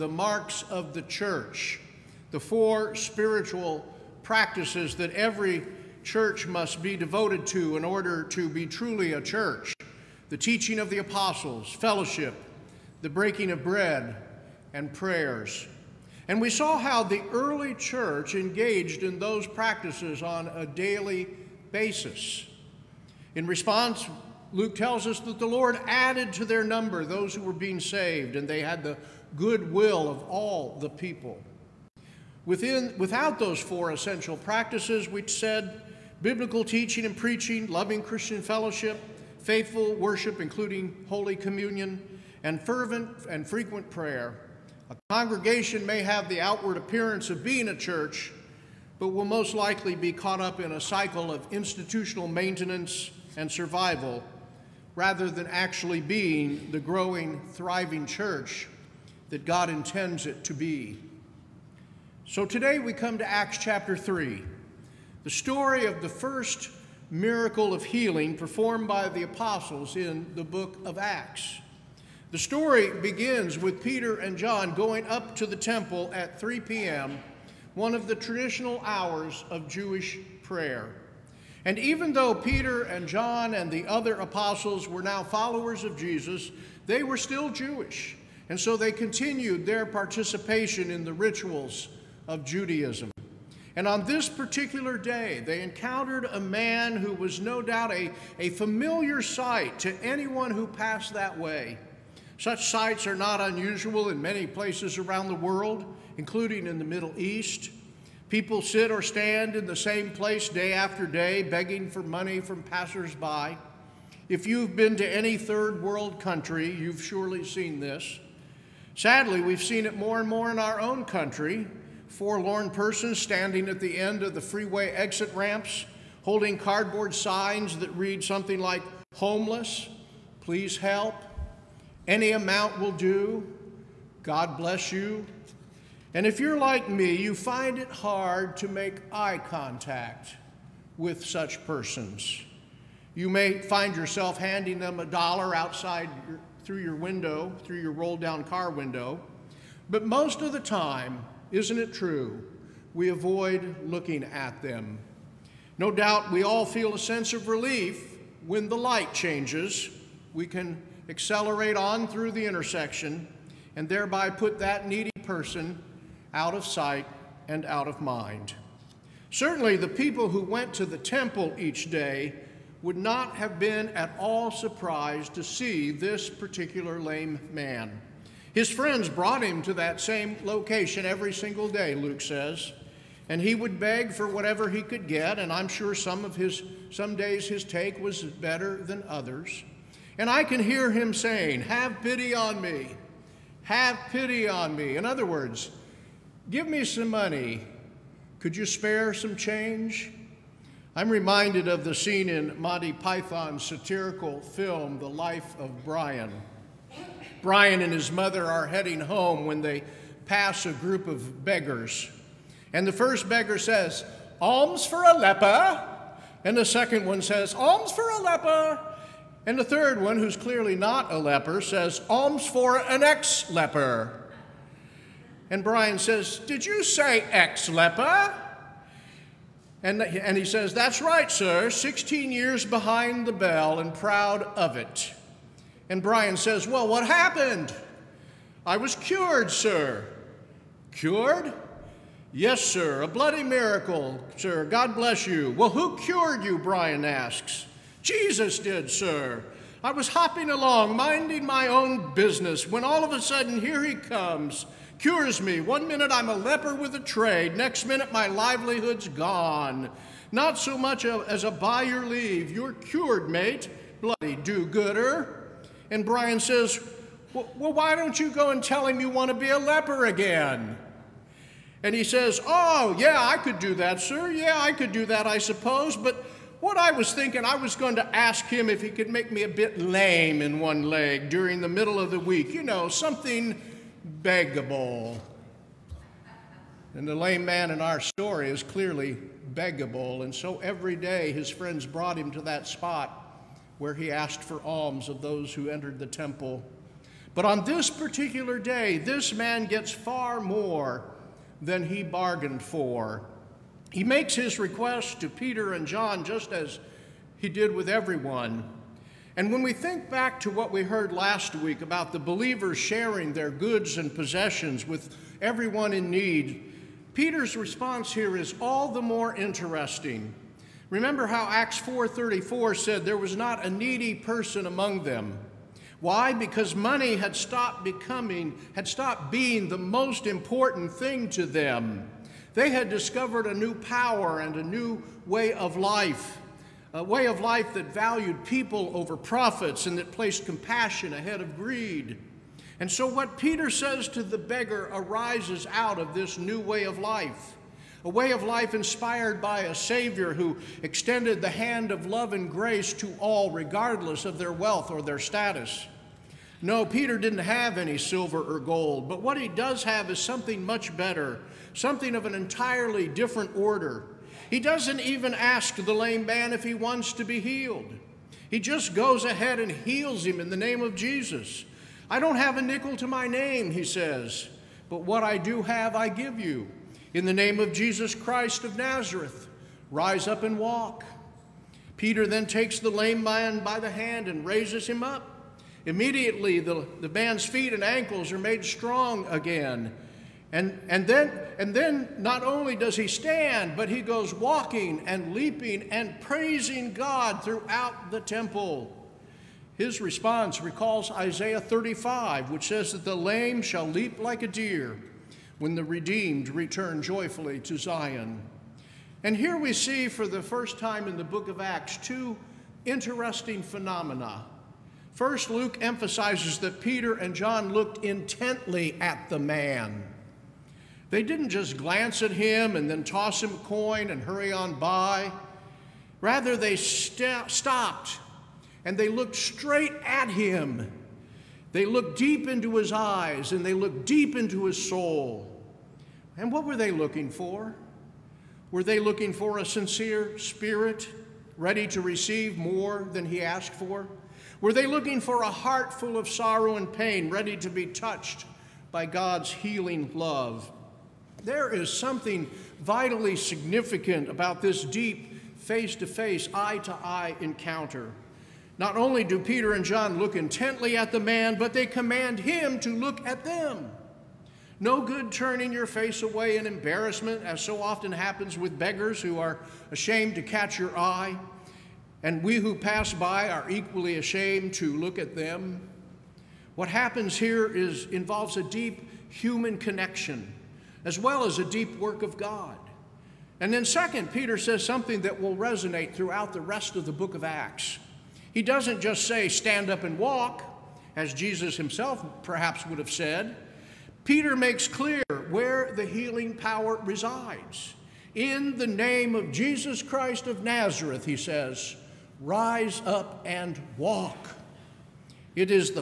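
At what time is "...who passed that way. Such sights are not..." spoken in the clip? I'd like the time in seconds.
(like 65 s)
100 s.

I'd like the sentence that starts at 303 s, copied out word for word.
He makes his request to Peter and John just as he did with everyone.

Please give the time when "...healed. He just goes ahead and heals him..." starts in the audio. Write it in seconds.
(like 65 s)
367 s.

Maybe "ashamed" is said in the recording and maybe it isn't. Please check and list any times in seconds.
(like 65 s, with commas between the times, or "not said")
469 s, 474 s.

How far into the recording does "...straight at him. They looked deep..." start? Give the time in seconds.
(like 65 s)
429 s.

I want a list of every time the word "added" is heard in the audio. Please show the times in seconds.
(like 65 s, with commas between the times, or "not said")
25 s.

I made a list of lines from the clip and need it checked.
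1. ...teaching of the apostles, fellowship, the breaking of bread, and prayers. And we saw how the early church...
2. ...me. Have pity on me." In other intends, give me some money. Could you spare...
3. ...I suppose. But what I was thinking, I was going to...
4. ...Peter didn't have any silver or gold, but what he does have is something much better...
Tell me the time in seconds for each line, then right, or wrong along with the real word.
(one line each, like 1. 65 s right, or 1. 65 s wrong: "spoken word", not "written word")
1. 10 s right
2. 192 s wrong: "words", not "intends"
3. 275 s right
4. 356 s right.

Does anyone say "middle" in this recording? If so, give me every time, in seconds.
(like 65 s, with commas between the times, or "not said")
106 s, 281 s.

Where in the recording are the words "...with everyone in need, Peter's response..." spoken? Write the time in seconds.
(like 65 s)
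314 s.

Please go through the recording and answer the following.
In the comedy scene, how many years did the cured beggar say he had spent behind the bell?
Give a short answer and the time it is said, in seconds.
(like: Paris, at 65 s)
16, at 231 s.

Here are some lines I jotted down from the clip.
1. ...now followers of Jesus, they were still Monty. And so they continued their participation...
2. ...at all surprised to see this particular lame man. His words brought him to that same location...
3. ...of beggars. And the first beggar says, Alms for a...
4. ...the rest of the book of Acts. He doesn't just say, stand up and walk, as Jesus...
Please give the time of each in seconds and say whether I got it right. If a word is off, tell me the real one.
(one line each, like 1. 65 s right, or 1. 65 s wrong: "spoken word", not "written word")
1. 85 s wrong: "Jewish", not "Monty"
2. 173 s wrong: "friends", not "words"
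3. 211 s right
4. 486 s right.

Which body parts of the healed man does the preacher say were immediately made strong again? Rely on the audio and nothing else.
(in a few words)
feet and ankles.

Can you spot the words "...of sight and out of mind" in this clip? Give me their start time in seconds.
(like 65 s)
166 s.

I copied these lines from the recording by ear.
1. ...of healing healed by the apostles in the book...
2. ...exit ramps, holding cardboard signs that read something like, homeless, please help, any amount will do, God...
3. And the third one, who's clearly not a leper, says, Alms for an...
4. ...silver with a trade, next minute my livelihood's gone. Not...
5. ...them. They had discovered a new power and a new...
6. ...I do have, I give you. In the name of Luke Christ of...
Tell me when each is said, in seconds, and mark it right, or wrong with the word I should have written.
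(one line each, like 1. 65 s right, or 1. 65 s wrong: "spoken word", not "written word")
1. 67 s wrong: "performed", not "healed"
2. 124 s right
3. 219 s right
4. 256 s wrong: "leper", not "silver"
5. 331 s right
6. 375 s wrong: "Jesus", not "Luke".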